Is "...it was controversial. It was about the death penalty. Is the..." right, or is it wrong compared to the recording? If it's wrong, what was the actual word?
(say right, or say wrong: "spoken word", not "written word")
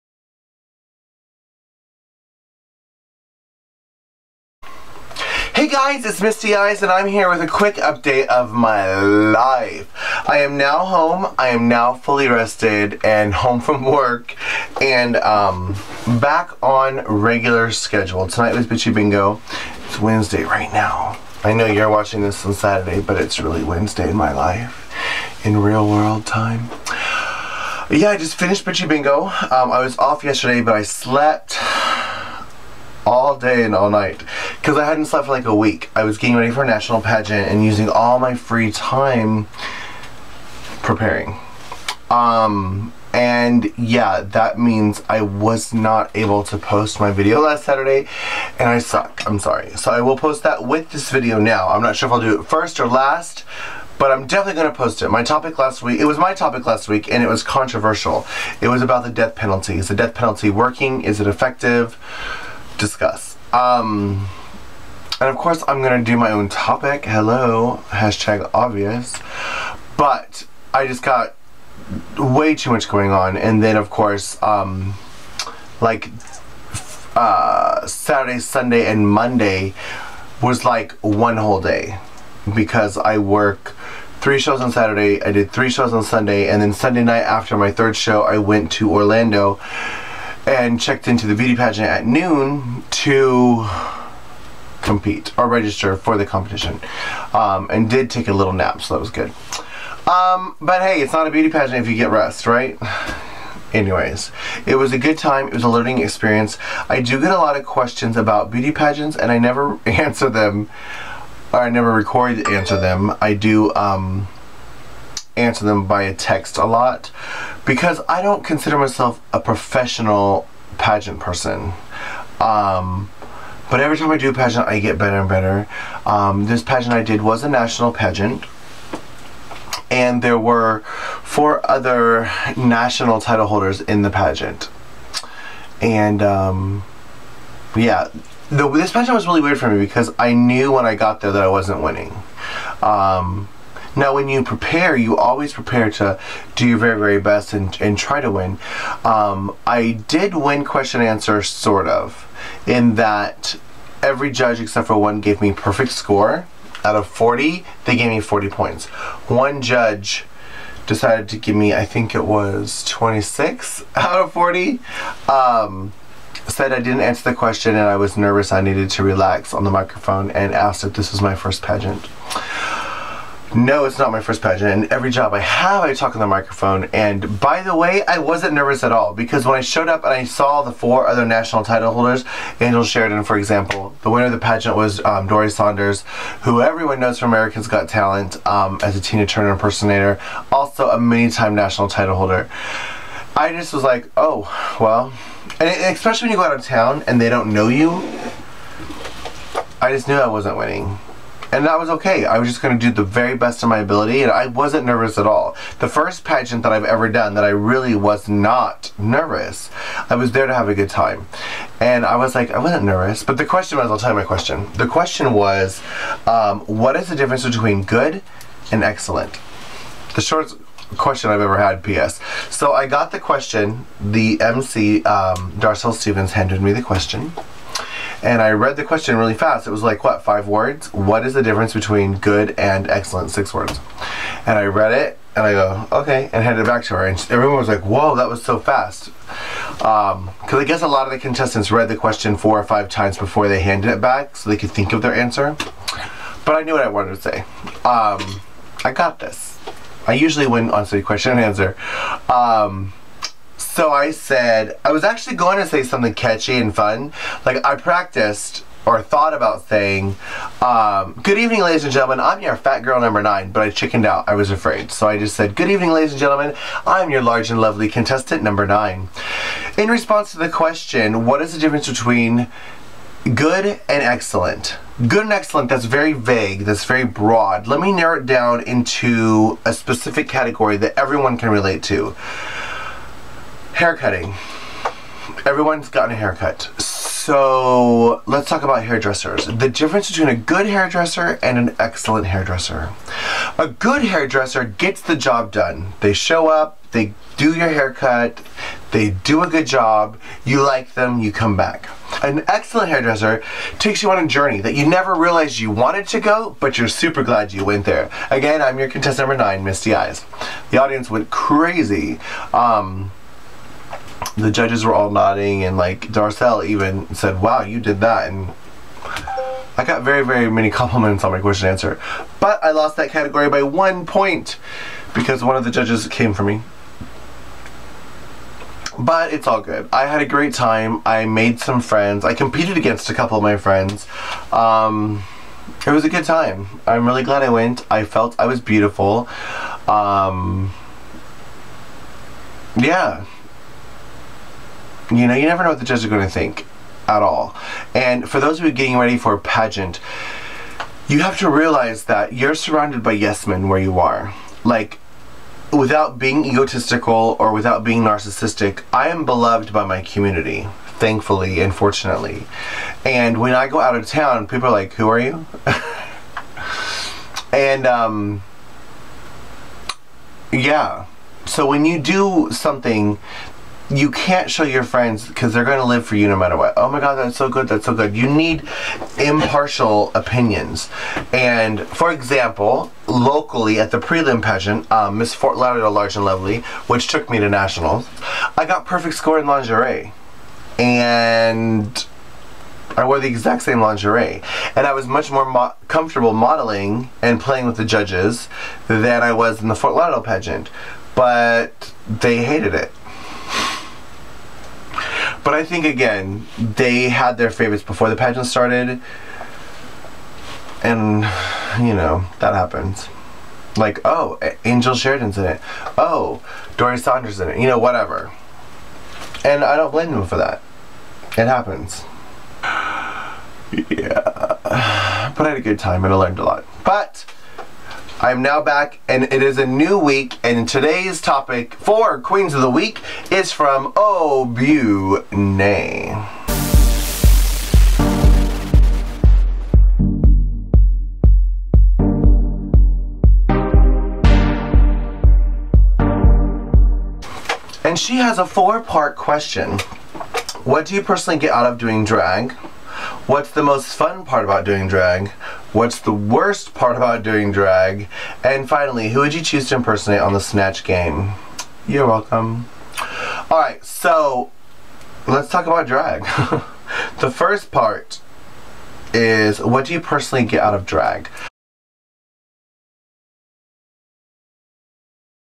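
right.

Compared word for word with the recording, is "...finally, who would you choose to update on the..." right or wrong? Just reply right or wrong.
wrong.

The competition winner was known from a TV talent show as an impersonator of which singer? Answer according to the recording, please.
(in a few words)
Tina Turner.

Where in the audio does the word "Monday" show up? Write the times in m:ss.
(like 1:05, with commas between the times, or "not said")
1:19.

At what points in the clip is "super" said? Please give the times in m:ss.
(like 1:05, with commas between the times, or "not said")
5:06.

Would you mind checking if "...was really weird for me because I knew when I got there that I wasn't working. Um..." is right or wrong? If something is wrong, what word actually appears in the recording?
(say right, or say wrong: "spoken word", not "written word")
wrong: "winning", not "working".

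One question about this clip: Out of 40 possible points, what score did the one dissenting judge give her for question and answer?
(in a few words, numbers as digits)
26.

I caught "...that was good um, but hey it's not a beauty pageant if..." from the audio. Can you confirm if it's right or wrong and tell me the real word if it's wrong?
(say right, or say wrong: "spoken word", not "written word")
right.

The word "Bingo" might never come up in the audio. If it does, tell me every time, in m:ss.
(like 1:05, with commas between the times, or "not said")
0:18, 0:28.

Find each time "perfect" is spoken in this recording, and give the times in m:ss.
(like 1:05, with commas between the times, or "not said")
2:35, 6:28.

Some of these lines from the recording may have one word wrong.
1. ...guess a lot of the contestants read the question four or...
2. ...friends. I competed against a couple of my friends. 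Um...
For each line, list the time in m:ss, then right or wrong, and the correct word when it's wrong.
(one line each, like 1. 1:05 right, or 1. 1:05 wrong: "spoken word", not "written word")
1. 4:00 right
2. 5:31 right.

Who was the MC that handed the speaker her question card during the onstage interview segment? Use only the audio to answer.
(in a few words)
Darcel Stevens.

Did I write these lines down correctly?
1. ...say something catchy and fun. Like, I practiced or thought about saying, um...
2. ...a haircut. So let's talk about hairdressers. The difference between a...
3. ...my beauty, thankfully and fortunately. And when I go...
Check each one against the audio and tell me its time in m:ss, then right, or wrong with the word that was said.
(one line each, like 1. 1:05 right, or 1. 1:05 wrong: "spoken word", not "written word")
1. 4:15 right
2. 4:46 right
3. 5:59 wrong: "community", not "beauty".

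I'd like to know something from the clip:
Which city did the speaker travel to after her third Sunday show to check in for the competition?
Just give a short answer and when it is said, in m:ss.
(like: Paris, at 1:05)
Orlando, at 1:28.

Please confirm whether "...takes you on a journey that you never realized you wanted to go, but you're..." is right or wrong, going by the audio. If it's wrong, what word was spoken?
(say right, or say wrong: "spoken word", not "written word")
right.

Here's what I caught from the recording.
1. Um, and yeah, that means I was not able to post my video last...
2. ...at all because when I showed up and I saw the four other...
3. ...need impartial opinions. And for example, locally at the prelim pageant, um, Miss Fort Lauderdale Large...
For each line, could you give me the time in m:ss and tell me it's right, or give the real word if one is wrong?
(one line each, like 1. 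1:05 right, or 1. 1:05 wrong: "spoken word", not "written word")
1. 0:42 right
2. 2:58 right
3. 6:18 right.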